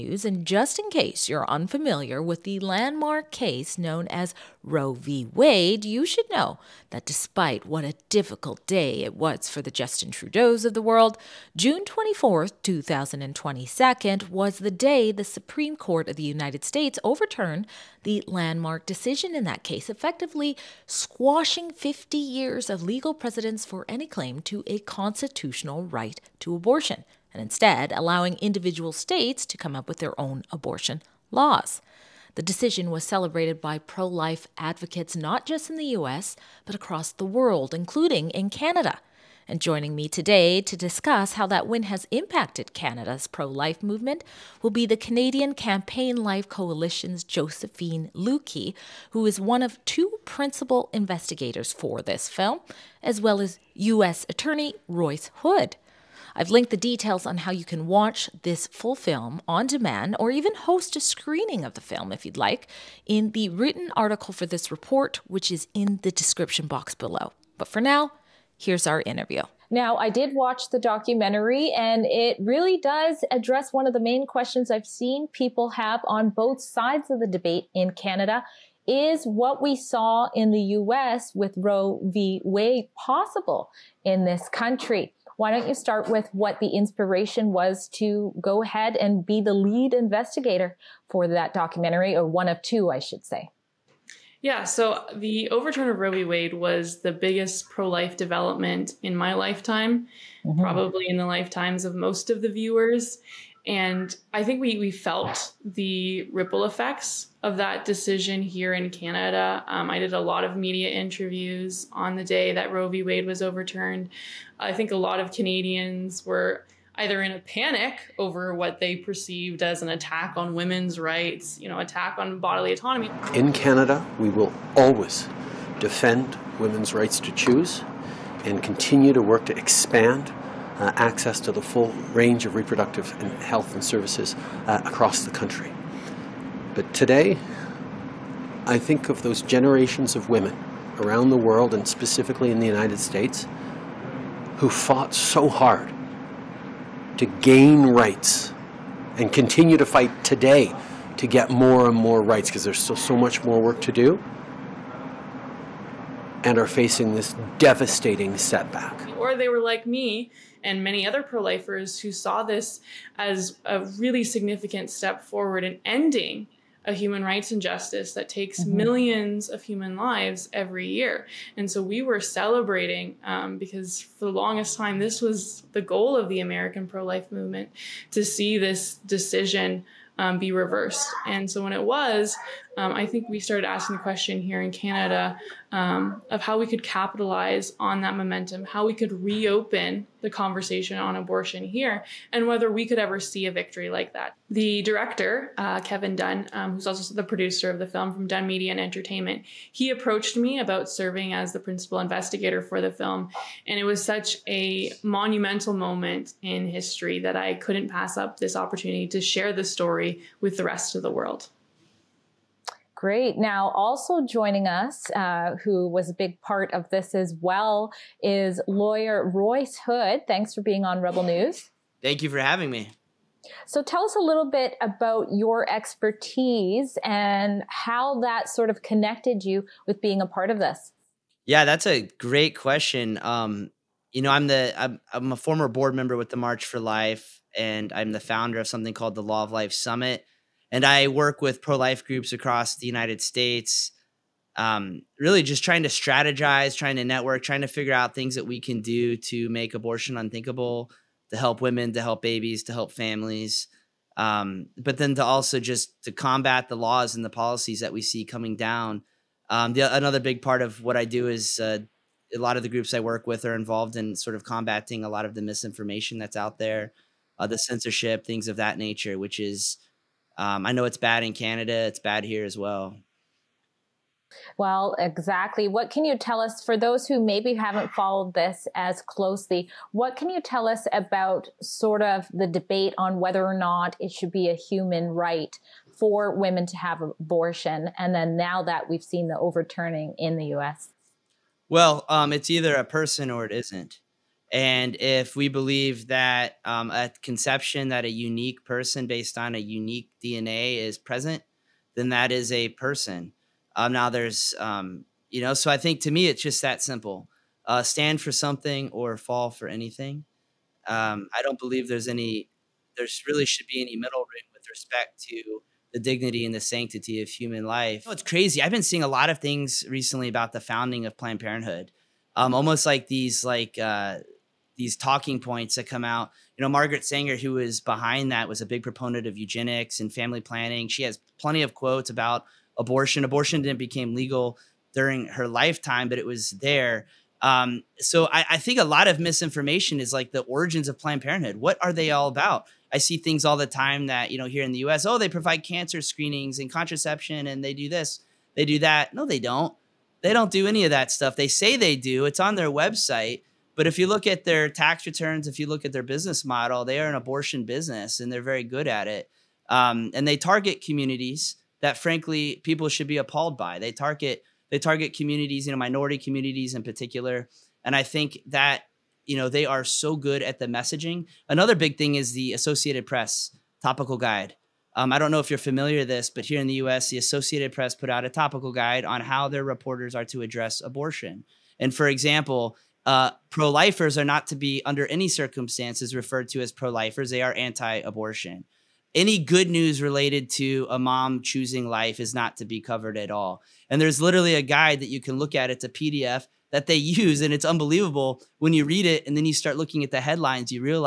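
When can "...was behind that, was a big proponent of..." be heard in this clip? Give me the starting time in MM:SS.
05:27.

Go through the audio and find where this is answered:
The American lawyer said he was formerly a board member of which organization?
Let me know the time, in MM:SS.
03:56.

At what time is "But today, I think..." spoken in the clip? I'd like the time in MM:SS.
02:16.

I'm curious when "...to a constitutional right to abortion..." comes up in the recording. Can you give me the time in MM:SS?
00:24.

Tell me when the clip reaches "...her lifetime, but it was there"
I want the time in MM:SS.
05:35.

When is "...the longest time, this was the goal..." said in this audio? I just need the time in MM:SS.
02:54.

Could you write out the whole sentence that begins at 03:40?
Thanks for being on Rebel News.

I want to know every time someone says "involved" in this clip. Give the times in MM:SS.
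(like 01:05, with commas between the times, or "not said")
04:23.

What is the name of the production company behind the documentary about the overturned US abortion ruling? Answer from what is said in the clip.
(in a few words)
Dunn Media and Entertainment.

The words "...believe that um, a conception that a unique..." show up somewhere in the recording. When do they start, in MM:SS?
04:55.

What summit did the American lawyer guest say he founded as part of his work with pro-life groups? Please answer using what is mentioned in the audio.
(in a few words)
Law of Life Summit.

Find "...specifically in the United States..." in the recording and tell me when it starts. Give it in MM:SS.
02:21.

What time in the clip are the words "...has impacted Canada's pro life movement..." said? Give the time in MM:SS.
00:41.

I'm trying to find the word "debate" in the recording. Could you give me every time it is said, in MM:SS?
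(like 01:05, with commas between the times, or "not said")
01:17, 04:42.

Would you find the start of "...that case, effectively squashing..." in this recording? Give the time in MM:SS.
00:19.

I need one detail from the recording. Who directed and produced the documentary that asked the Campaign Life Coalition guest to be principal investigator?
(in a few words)
Kevin Dunn.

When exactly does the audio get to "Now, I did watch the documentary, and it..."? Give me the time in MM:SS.
01:09.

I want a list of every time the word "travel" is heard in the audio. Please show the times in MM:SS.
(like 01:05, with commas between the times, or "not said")
not said.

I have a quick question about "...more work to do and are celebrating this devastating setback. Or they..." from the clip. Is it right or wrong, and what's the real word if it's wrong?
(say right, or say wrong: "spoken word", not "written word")
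wrong: "facing", not "celebrating".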